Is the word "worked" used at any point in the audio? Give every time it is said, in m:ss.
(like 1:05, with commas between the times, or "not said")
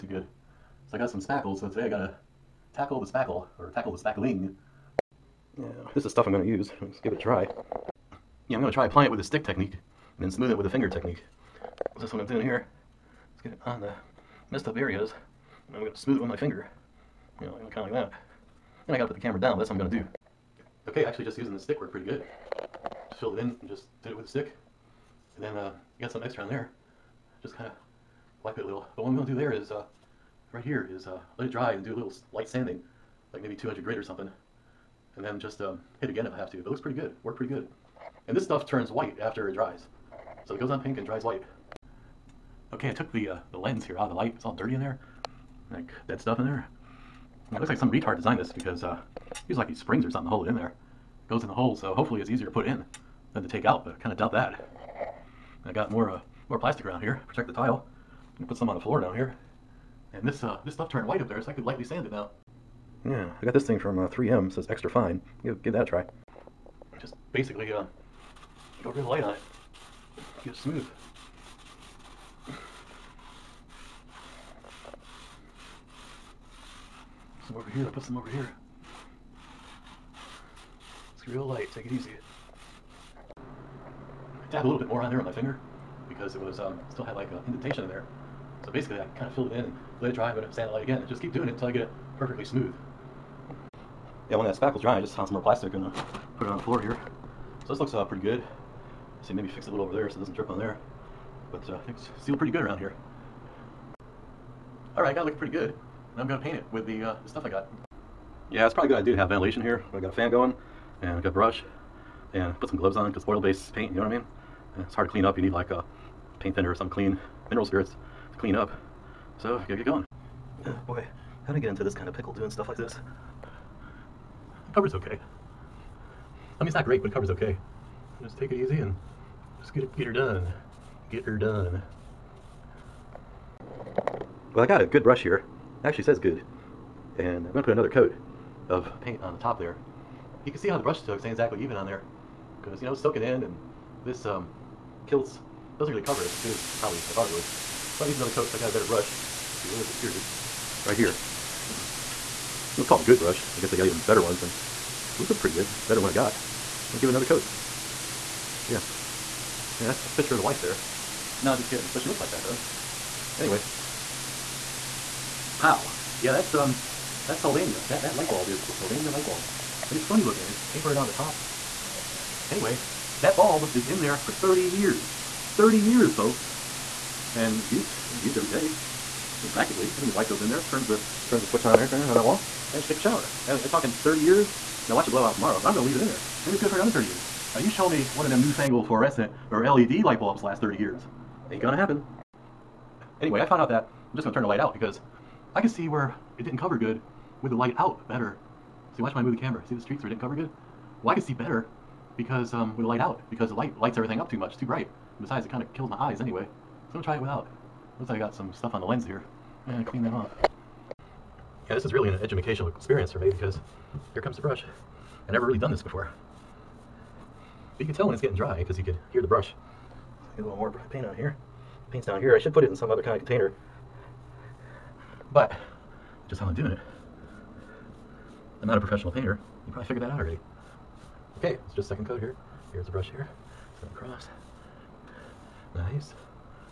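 0:21, 0:37.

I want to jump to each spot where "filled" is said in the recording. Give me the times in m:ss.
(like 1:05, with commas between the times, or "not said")
0:23, 1:29.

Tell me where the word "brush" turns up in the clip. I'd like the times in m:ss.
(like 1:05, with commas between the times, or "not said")
1:51, 2:15, 2:20, 2:28, 2:33, 3:34, 3:39, 3:52.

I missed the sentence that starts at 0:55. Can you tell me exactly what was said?
I got more uh, more plastic around here, protect the tile.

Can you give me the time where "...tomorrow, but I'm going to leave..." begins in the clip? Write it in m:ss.
3:05.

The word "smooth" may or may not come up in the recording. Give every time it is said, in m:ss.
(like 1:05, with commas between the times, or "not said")
0:10, 0:15, 1:10, 1:32.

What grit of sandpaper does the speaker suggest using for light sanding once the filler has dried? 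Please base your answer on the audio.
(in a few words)
200.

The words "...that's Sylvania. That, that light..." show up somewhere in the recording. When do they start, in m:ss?
2:47.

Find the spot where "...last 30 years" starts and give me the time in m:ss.
3:10.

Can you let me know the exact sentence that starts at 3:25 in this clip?
And besides, it kind of kills my eyes anyway.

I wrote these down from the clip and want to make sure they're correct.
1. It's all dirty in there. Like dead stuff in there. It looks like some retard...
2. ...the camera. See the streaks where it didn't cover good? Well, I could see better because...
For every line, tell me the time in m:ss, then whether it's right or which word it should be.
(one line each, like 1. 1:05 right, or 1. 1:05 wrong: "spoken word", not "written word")
1. 0:44 right
2. 3:19 right.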